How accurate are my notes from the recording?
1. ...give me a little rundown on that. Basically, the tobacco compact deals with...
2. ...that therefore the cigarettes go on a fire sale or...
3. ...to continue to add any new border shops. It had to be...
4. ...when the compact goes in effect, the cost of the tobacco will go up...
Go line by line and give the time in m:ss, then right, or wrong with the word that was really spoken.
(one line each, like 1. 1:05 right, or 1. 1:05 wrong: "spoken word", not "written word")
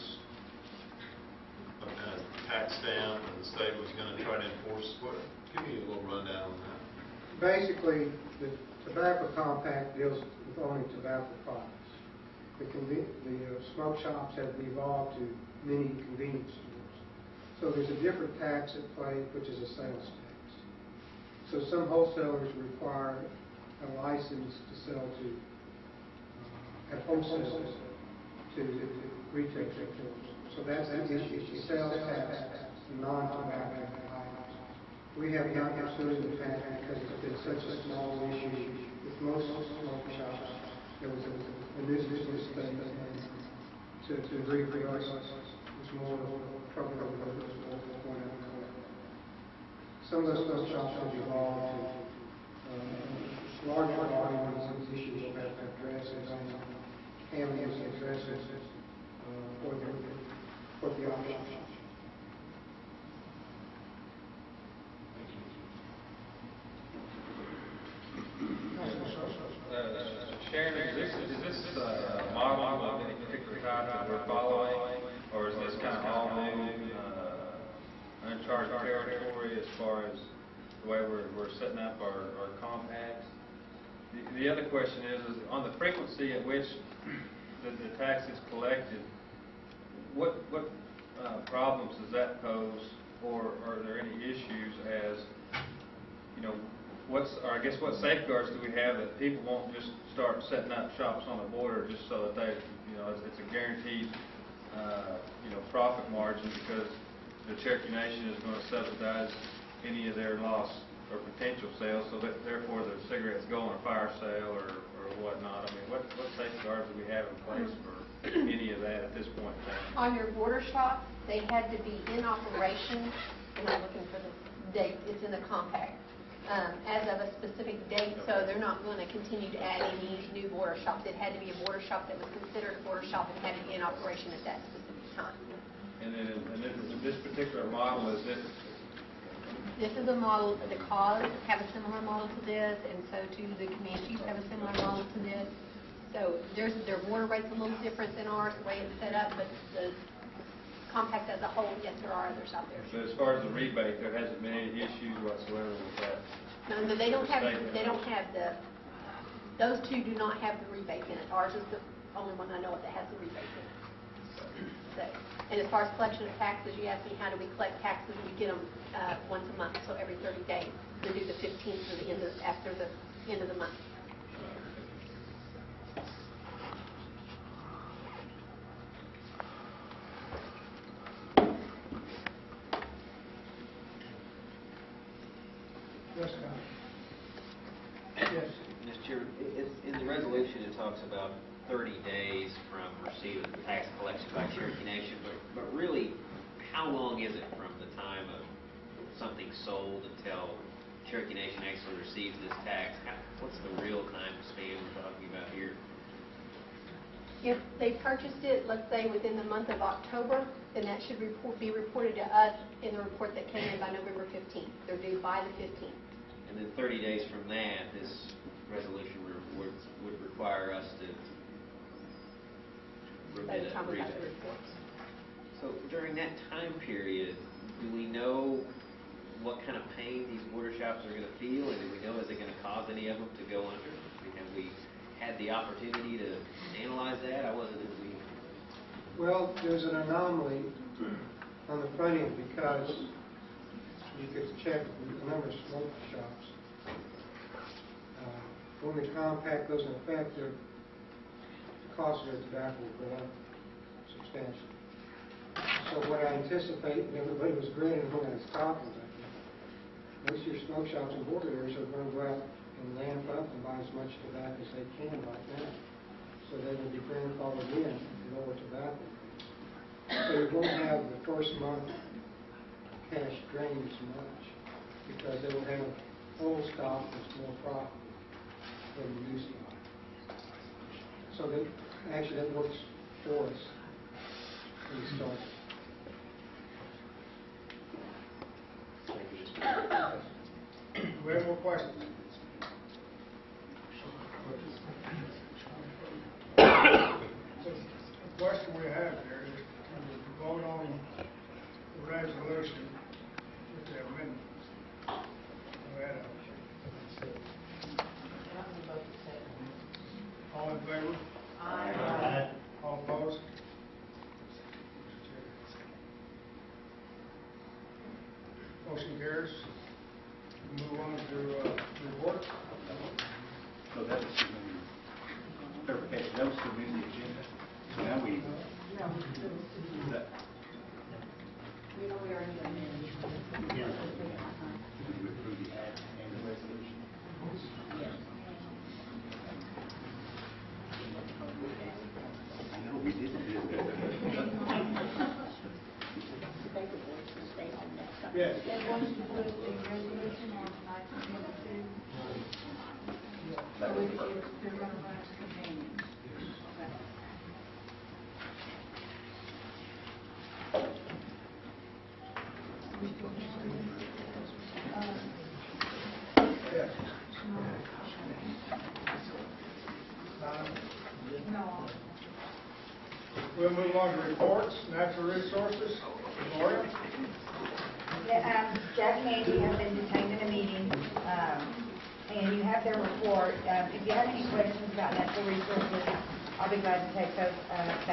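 1. 0:05 right
2. 1:52 right
3. 2:08 right
4. 4:08 right.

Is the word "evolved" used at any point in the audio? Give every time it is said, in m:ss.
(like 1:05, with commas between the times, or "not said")
0:14, 0:51.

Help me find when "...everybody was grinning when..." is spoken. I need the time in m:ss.
4:17.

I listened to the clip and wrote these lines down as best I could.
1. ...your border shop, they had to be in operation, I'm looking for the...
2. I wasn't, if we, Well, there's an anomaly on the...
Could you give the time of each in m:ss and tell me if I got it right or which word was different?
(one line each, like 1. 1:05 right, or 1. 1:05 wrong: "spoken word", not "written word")
1. 2:00 right
2. 3:57 right.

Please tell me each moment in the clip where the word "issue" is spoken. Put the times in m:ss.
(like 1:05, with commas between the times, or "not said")
0:31, 0:38, 0:54, 1:34, 2:34.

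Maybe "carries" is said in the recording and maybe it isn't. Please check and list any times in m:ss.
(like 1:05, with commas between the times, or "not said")
5:19.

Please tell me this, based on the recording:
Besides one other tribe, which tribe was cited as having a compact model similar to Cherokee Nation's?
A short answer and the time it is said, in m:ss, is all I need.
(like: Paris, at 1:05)
Comanches, at 2:23.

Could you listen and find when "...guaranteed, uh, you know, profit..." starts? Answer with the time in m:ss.
1:43.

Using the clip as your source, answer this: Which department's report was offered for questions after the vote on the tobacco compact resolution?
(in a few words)
natural resources.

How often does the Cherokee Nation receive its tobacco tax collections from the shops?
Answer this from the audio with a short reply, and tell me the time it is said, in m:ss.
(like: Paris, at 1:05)
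once a month, at 2:49.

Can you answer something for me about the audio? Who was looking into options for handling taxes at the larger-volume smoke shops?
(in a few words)
Diane Hammons.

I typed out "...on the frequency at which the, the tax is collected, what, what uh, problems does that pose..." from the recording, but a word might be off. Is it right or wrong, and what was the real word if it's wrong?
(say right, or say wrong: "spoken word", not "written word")
right.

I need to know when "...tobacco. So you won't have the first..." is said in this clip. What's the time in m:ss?
4:28.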